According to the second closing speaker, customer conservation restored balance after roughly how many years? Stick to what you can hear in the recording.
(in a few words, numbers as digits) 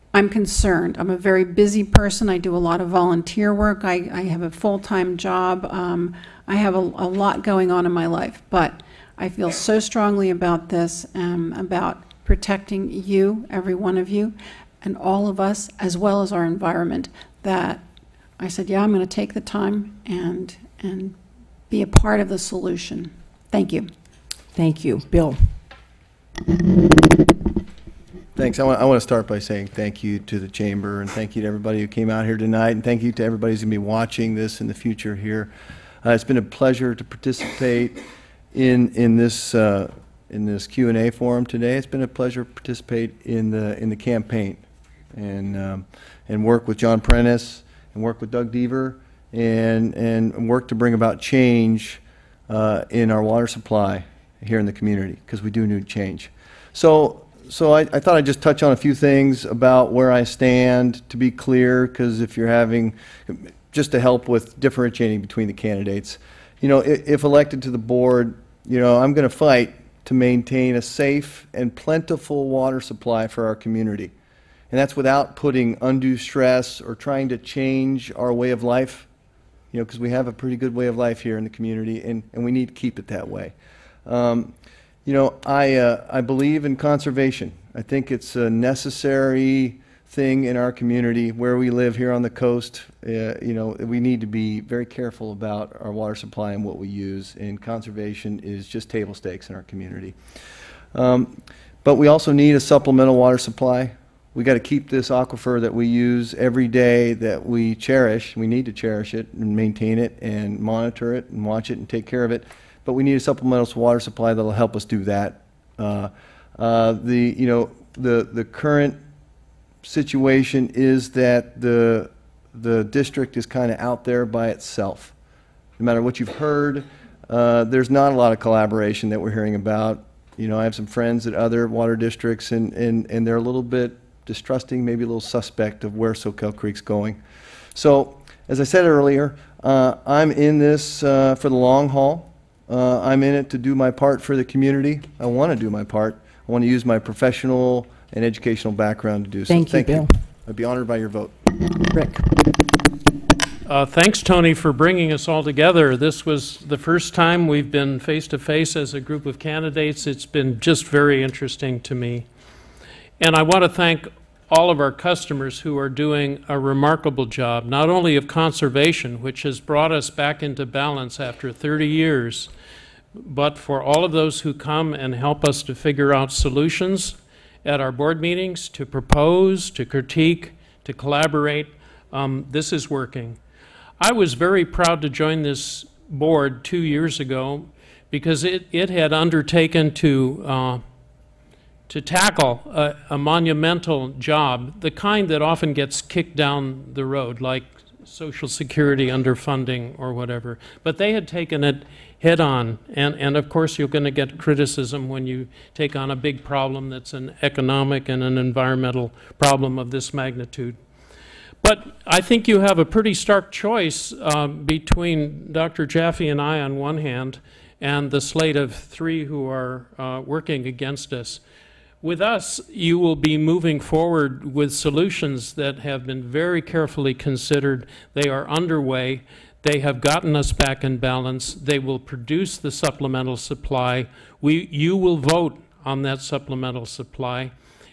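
30 years.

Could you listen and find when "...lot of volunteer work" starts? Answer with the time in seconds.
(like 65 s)
2 s.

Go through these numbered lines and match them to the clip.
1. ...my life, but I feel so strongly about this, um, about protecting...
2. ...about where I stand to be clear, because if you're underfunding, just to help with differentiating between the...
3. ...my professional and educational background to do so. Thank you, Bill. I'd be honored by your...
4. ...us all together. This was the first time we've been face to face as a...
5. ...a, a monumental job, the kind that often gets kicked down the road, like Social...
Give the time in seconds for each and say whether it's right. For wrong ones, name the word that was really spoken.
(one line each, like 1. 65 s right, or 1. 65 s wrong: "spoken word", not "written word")
1. 7 s right
2. 59 s wrong: "having", not "underfunding"
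3. 146 s right
4. 155 s right
5. 192 s right.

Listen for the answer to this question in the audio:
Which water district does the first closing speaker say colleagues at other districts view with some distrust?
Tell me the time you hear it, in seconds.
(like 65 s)
136 s.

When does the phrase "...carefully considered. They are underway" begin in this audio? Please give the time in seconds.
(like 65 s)
226 s.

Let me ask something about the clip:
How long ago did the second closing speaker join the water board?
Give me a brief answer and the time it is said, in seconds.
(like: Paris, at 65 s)
2 years ago, at 186 s.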